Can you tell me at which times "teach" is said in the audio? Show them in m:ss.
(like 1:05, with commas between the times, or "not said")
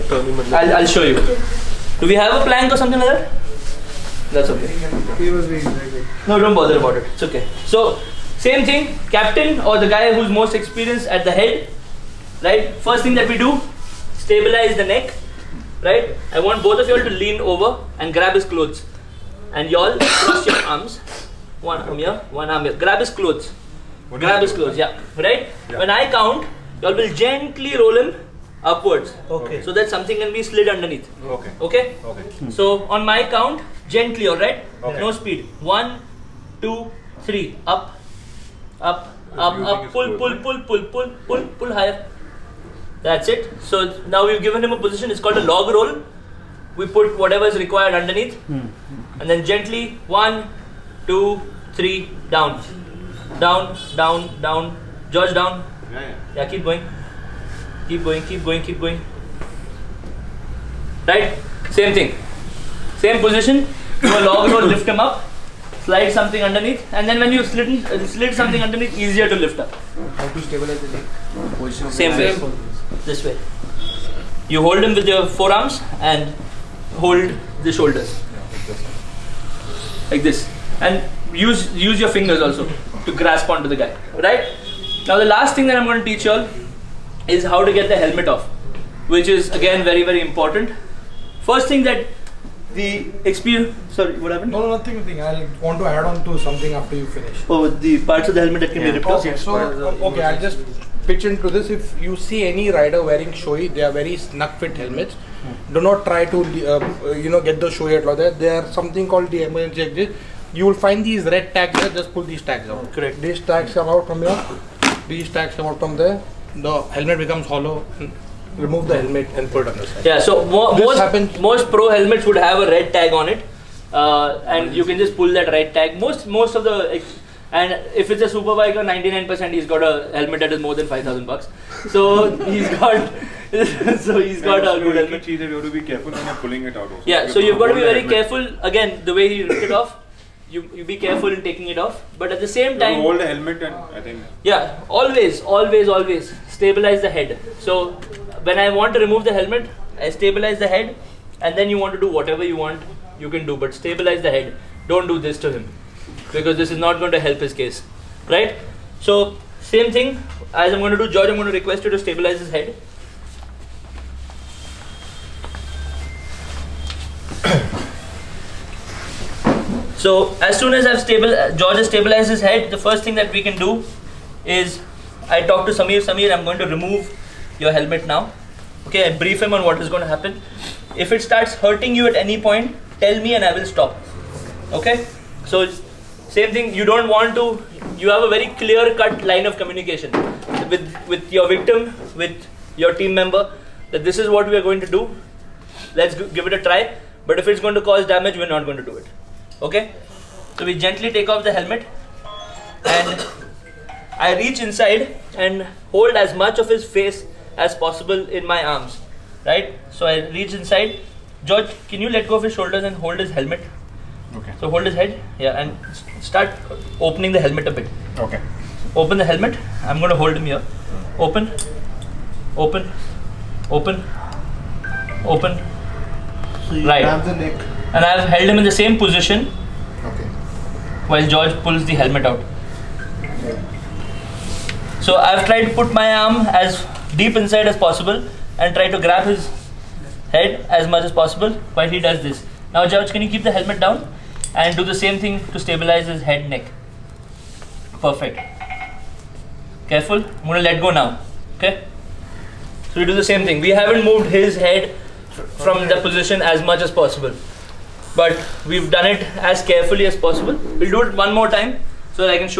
1:26.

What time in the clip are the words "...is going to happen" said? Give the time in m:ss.
2:59.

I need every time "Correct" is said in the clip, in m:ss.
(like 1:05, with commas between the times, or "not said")
1:52.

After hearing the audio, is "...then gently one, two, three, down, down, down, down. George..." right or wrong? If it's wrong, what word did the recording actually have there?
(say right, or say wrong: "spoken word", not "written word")
right.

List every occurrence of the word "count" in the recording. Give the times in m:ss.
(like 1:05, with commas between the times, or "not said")
0:26, 0:33.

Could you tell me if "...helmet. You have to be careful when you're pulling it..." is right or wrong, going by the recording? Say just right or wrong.
right.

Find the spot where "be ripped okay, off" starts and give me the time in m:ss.
1:38.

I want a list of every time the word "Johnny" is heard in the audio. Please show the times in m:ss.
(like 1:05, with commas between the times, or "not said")
not said.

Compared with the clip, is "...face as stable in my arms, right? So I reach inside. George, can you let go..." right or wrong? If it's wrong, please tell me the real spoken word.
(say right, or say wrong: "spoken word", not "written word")
wrong: "possible", not "stable".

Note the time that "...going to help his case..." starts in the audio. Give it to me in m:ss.
2:37.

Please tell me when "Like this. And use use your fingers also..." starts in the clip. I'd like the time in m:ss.
1:20.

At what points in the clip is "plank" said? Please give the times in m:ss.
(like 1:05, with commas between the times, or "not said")
0:02.